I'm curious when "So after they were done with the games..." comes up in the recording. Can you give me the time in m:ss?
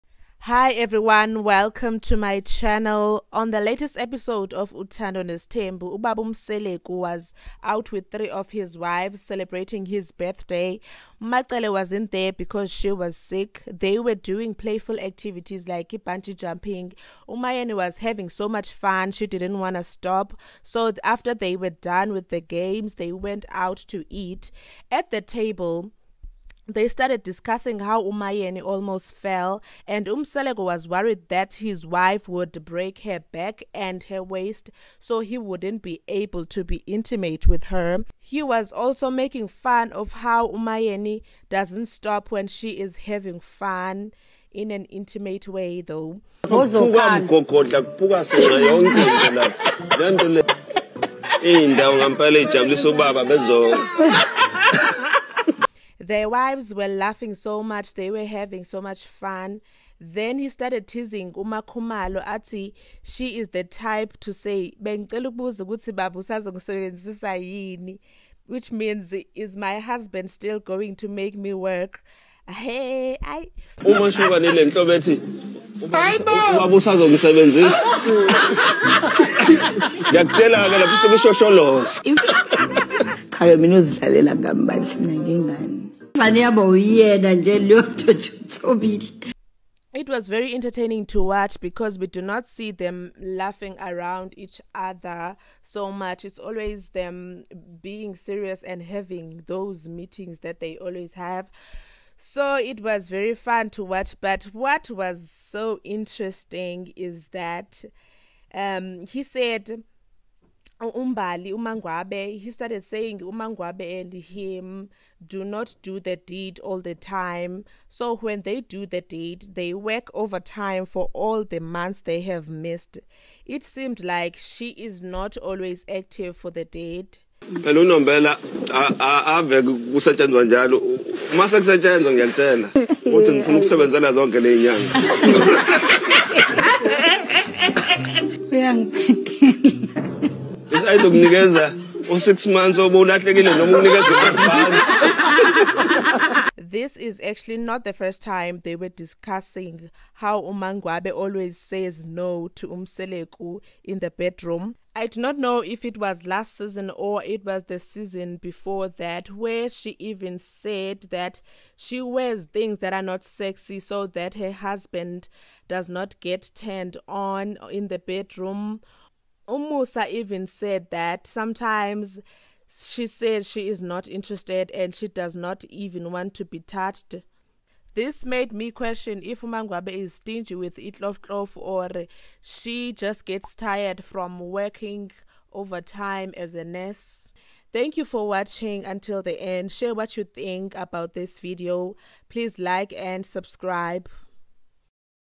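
0:20.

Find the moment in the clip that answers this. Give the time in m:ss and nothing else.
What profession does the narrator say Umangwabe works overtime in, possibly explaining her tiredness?
3:06.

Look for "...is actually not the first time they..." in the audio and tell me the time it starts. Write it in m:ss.
2:26.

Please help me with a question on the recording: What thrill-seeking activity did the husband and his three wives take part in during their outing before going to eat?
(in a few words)
Bungee jumping.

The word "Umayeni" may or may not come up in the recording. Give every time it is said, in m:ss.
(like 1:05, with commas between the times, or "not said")
0:17, 0:28, 0:40.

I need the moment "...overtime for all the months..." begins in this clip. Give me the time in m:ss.
2:00.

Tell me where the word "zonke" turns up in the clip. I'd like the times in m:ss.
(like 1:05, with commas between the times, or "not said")
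2:14.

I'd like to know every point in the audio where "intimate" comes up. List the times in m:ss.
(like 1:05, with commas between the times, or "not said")
0:36, 0:44.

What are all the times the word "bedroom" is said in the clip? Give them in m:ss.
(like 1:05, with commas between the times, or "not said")
2:34, 2:47.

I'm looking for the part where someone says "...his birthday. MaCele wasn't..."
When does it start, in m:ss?
0:09.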